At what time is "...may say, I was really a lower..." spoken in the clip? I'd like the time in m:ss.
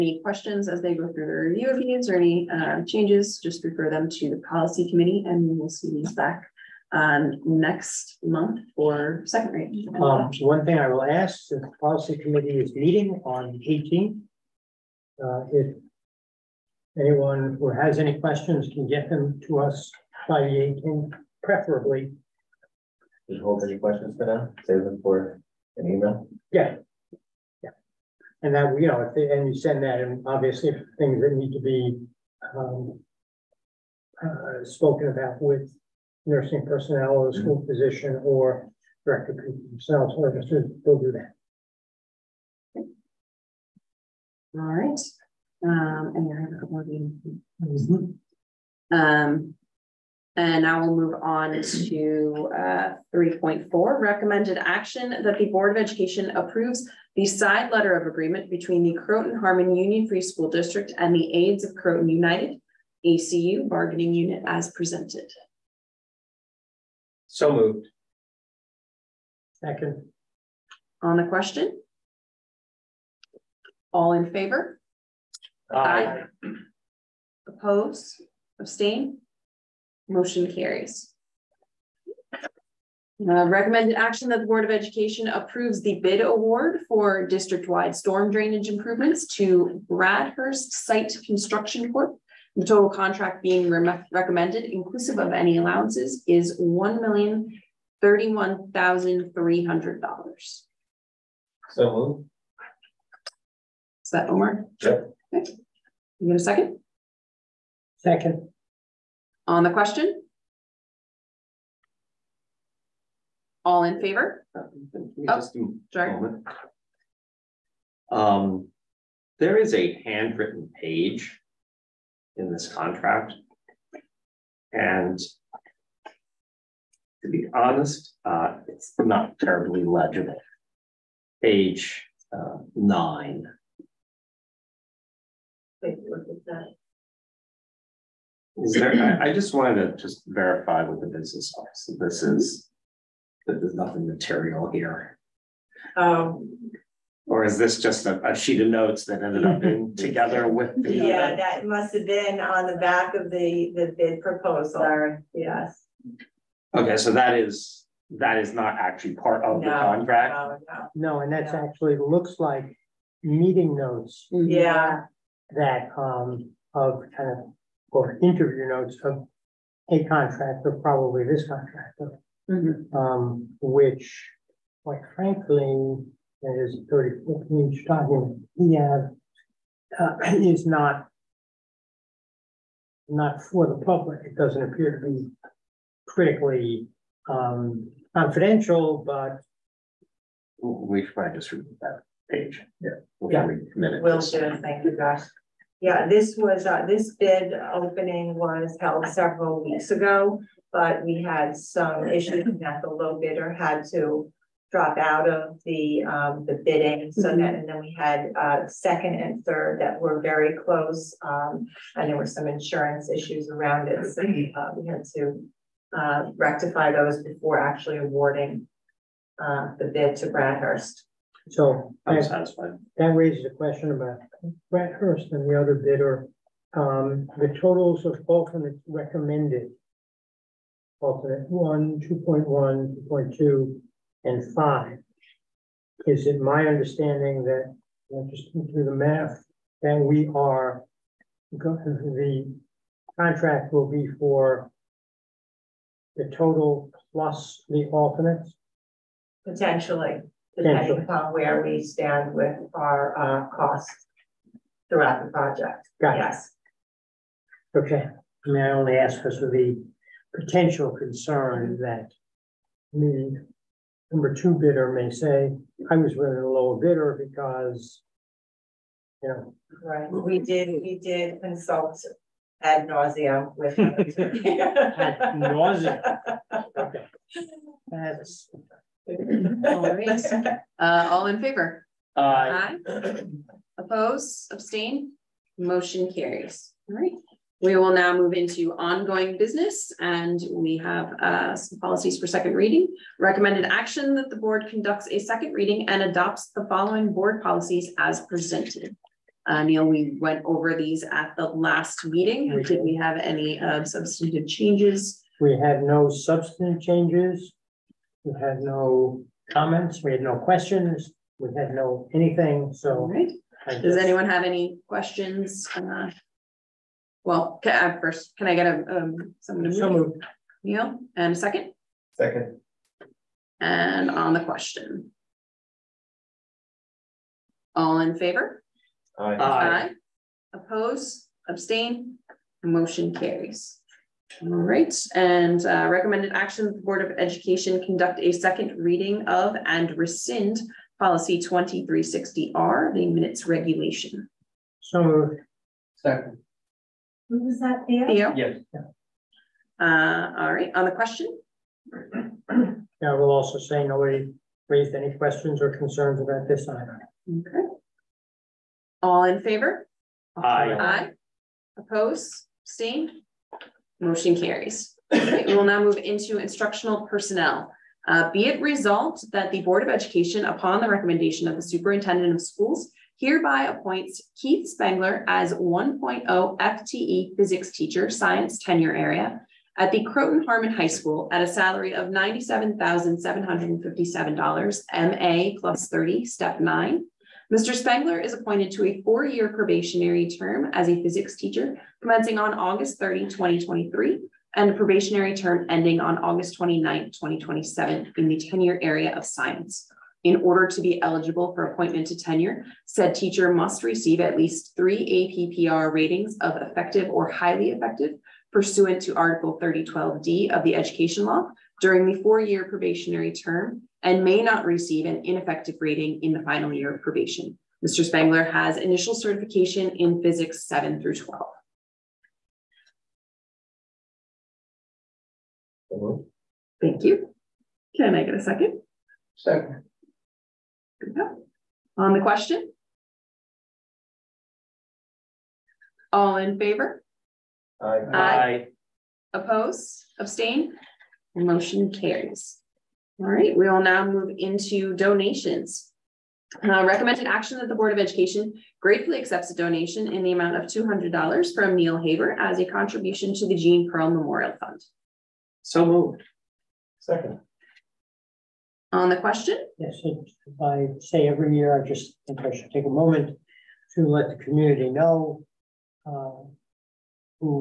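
4:24.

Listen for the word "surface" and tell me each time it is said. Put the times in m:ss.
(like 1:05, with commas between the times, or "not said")
not said.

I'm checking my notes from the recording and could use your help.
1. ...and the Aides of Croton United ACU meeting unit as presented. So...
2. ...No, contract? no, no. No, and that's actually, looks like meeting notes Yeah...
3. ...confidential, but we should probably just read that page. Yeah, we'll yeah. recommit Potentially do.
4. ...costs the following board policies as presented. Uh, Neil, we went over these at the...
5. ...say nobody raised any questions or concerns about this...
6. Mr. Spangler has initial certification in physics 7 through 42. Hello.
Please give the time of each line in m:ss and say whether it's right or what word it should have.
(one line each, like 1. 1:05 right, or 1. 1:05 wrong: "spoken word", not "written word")
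1. 1:00 wrong: "bargaining", not "meeting"
2. 2:39 right
3. 3:08 wrong: "Will", not "Potentially"
4. 4:56 wrong: "adopts", not "costs"
5. 5:53 right
6. 6:57 wrong: "12", not "42".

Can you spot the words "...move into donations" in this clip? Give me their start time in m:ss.
7:24.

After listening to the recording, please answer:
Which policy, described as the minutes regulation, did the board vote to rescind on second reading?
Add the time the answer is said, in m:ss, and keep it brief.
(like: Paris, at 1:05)
2360R, at 5:41.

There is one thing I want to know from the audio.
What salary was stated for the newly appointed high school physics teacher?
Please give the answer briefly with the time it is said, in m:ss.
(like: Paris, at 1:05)
$97,757, at 6:22.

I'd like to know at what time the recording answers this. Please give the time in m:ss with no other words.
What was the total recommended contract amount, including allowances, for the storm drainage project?
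1:36.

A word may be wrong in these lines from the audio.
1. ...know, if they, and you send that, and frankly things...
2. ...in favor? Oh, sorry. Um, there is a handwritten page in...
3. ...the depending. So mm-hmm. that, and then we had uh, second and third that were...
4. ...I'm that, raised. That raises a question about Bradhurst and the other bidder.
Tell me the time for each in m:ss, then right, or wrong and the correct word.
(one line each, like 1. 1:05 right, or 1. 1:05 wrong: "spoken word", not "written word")
1. 0:28 wrong: "obviously", not "frankly"
2. 1:53 right
3. 3:26 wrong: "bidding", not "depending"
4. 3:42 wrong: "satisfied", not "raised".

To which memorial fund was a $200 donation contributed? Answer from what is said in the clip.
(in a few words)
Gene Pearl Memorial Fund.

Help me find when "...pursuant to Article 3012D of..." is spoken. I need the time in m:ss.
6:48.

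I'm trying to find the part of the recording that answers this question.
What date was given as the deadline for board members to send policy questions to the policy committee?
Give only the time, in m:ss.
0:20.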